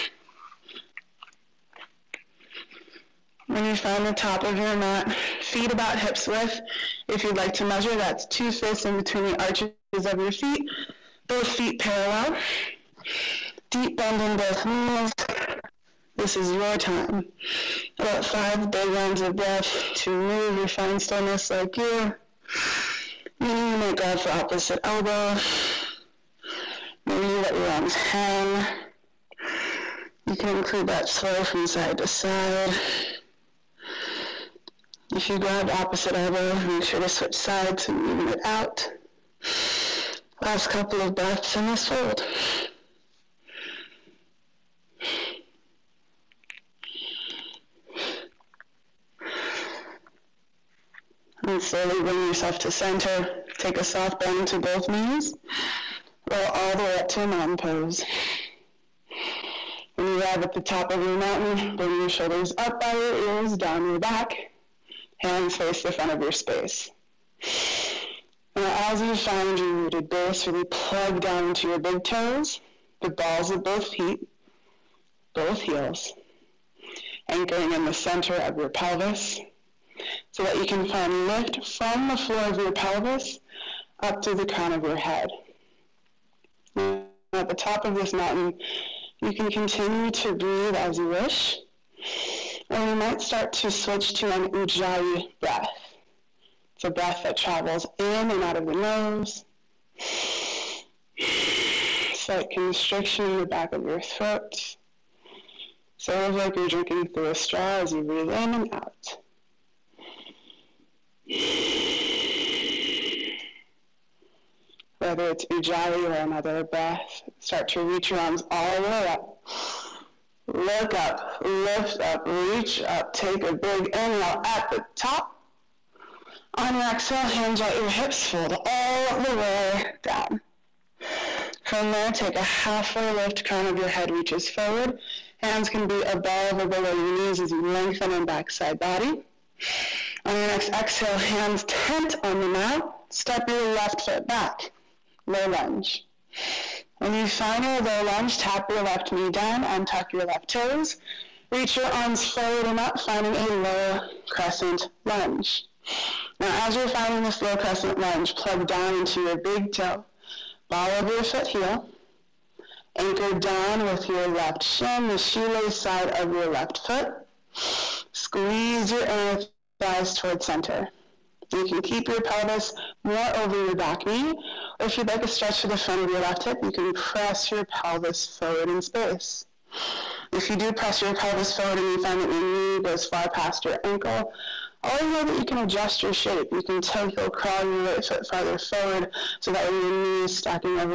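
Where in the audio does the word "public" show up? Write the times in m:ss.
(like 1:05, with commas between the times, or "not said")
not said.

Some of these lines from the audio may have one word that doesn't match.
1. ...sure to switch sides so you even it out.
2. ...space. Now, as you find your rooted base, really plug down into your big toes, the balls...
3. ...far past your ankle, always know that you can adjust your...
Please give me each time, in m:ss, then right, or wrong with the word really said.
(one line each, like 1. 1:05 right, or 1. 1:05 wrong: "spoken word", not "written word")
1. 0:36 right
2. 1:06 right
3. 3:03 right.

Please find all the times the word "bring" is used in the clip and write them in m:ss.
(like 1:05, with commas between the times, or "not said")
0:52, 1:01.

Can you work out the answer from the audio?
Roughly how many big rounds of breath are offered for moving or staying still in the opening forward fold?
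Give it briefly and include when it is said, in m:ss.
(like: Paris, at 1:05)
5, at 0:18.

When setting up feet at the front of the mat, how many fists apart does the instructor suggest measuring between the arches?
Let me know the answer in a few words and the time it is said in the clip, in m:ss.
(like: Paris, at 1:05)
2, at 0:08.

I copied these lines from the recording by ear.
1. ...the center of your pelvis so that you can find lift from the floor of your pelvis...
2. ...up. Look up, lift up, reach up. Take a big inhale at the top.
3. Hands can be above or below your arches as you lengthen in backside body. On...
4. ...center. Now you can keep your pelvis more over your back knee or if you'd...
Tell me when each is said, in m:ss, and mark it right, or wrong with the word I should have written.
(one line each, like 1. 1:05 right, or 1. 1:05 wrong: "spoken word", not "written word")
1. 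1:17 right
2. 1:59 right
3. 2:15 wrong: "knees", not "arches"
4. 2:50 right.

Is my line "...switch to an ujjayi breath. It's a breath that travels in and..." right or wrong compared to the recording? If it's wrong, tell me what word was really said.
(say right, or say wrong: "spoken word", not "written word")
right.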